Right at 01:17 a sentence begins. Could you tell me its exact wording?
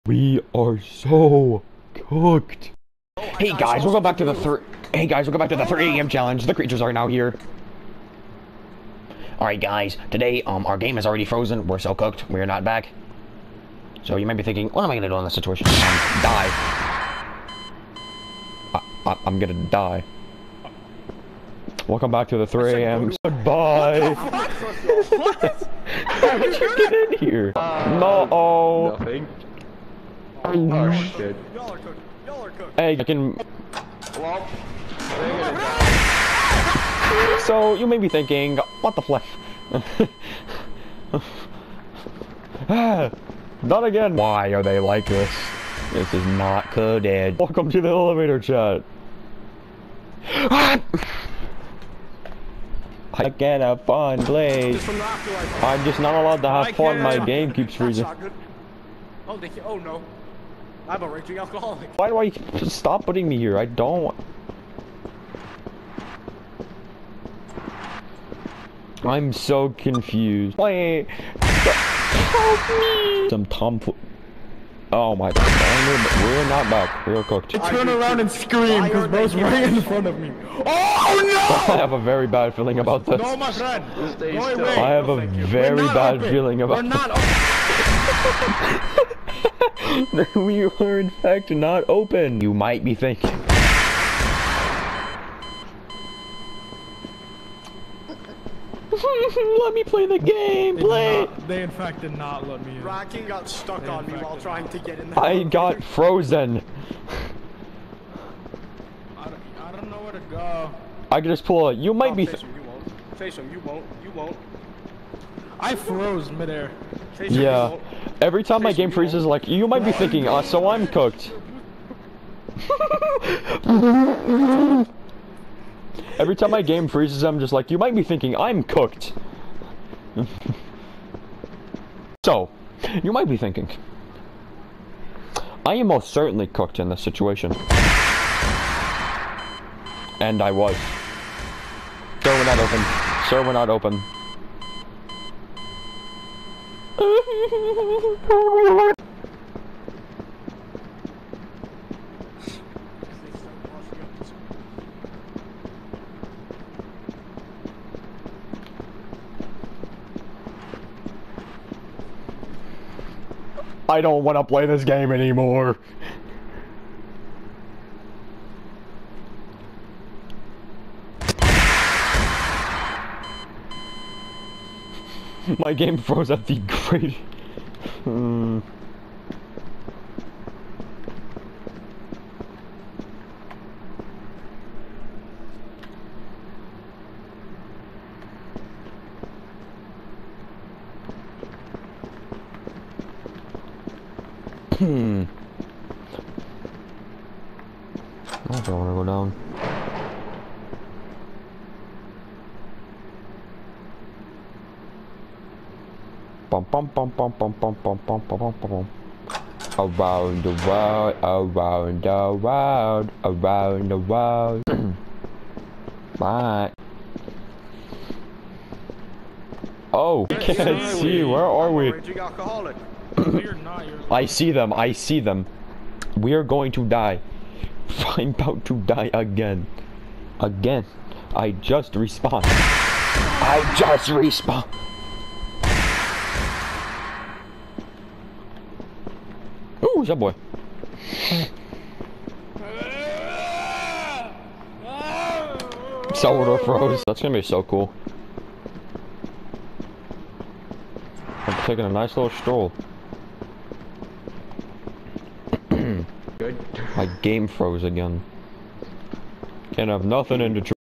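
I turn around and scream because bro's right in front of me.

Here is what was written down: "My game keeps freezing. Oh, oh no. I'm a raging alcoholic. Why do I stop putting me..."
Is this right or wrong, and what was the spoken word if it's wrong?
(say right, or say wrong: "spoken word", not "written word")
right.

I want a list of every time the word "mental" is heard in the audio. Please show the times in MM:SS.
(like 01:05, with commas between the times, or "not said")
not said.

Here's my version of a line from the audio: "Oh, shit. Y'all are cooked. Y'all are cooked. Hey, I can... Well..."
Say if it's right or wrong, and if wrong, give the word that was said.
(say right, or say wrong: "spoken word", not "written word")
right.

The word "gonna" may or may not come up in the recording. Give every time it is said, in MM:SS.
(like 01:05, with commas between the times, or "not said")
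00:14, 00:19, 04:07.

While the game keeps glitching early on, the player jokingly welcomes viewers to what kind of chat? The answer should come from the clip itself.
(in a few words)
elevator chat.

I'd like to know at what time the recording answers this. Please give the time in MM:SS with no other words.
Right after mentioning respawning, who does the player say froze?
04:06.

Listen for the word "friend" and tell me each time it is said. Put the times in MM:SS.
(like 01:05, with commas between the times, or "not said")
01:23.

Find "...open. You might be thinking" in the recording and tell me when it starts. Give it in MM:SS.
01:31.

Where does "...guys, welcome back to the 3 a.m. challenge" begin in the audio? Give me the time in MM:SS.
00:05.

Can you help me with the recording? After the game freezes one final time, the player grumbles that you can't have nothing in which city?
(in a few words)
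Detroit.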